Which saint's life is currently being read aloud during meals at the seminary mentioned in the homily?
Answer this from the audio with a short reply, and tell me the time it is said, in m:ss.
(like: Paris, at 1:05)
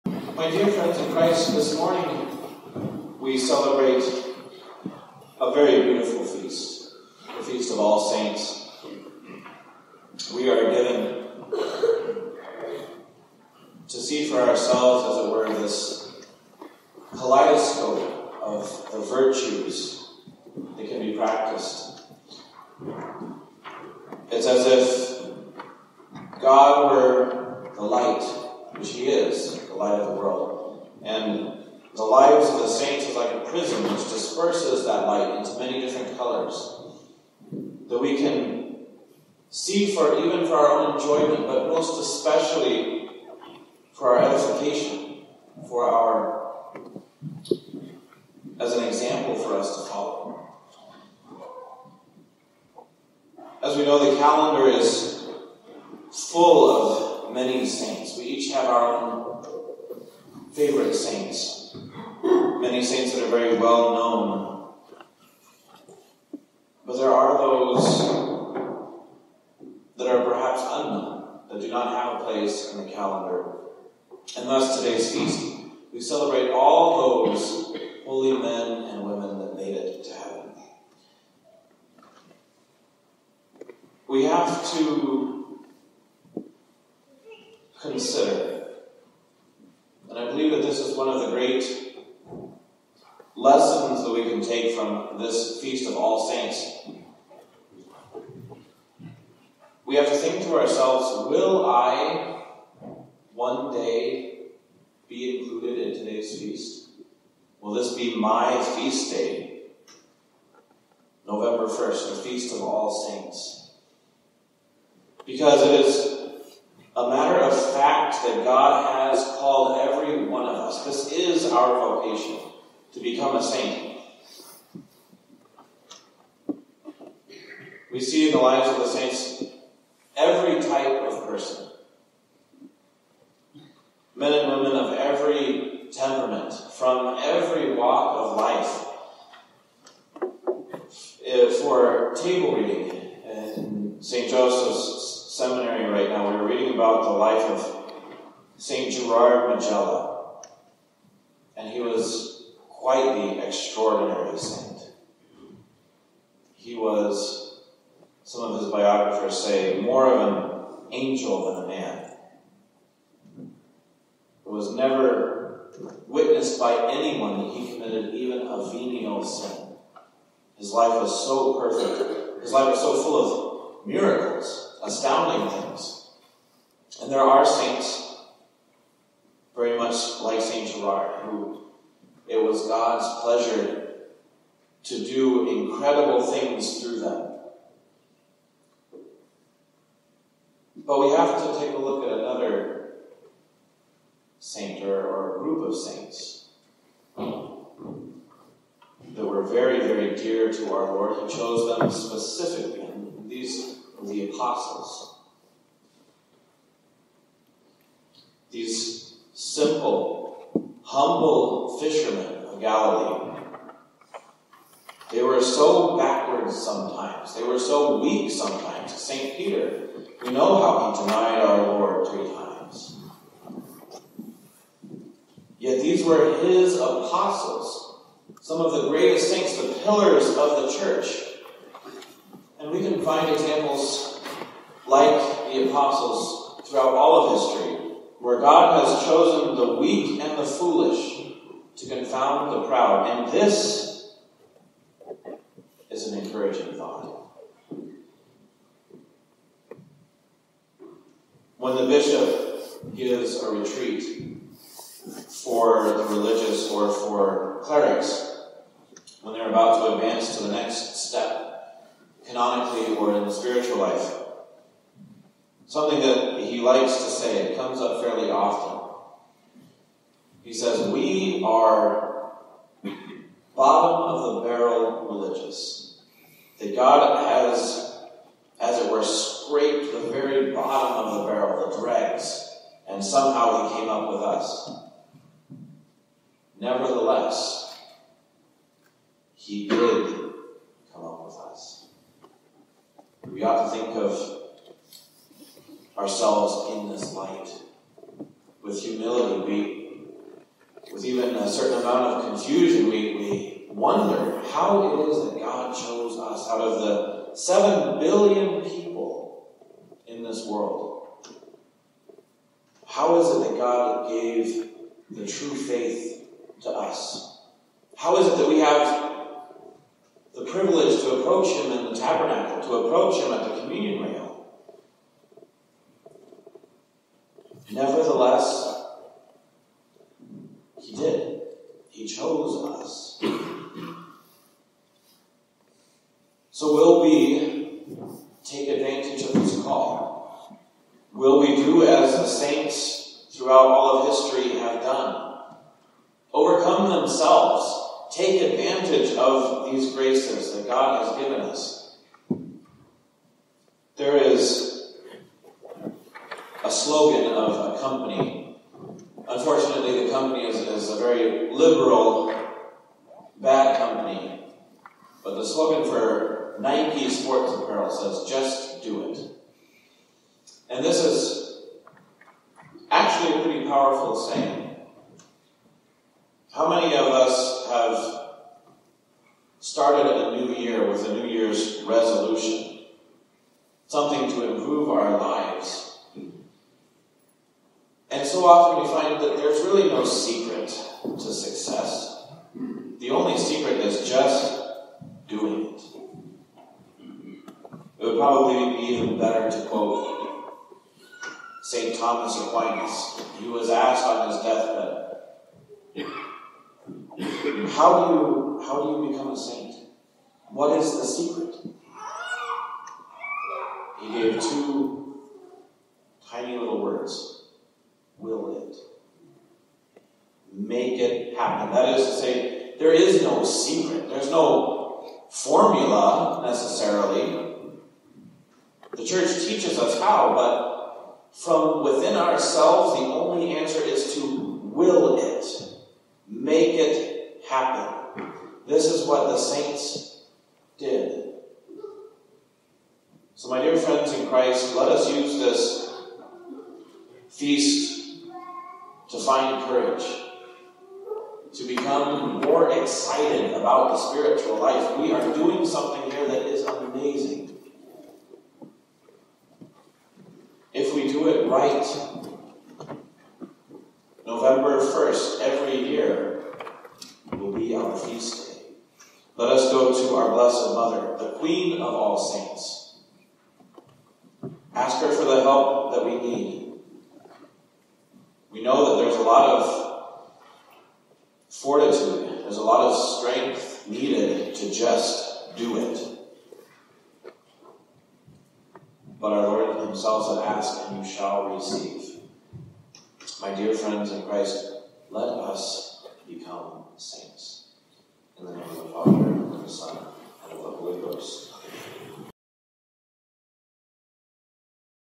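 St. Gerard Majella, at 2:28.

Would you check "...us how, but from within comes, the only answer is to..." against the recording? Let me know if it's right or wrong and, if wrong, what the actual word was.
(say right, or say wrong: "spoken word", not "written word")
wrong: "ourselves", not "comes".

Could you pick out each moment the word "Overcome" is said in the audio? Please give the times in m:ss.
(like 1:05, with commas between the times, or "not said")
5:46.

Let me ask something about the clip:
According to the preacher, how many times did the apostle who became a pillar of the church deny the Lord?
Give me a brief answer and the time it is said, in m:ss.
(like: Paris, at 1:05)
3, at 3:42.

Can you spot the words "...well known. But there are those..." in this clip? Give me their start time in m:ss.
1:03.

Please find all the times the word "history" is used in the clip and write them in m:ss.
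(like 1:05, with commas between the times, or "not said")
3:57, 5:44.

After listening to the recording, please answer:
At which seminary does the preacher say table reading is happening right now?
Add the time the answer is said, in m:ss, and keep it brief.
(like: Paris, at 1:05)
St. Joseph's Seminary, at 2:23.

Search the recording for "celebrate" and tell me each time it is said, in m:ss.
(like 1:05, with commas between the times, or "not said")
0:03, 1:15.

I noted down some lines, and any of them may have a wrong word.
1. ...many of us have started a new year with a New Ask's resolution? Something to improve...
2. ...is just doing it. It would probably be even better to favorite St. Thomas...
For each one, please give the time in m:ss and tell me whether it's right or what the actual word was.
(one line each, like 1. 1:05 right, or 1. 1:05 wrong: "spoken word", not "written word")
1. 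6:16 wrong: "Year", not "Ask"
2. 6:33 wrong: "quote", not "favorite".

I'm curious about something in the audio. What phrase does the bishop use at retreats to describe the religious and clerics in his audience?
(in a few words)
bottom of the barrel religious.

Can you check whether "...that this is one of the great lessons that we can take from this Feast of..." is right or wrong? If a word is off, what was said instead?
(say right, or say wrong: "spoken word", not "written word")
right.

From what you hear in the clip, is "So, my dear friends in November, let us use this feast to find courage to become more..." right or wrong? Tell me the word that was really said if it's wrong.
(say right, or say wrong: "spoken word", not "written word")
wrong: "Christ", not "November".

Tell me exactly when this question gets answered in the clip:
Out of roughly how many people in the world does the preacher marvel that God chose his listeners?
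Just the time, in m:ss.
5:07.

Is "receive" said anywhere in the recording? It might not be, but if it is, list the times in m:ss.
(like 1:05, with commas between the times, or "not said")
8:11.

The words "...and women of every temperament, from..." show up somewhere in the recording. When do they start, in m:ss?
2:14.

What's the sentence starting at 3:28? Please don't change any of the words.
These simple humble fishermen of Galilee.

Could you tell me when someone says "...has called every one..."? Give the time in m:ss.
1:59.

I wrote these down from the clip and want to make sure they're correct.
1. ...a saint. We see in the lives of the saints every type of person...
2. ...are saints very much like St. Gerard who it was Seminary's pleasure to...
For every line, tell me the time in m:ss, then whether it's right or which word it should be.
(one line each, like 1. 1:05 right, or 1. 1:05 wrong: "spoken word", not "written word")
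1. 2:03 right
2. 2:57 wrong: "God", not "Seminary".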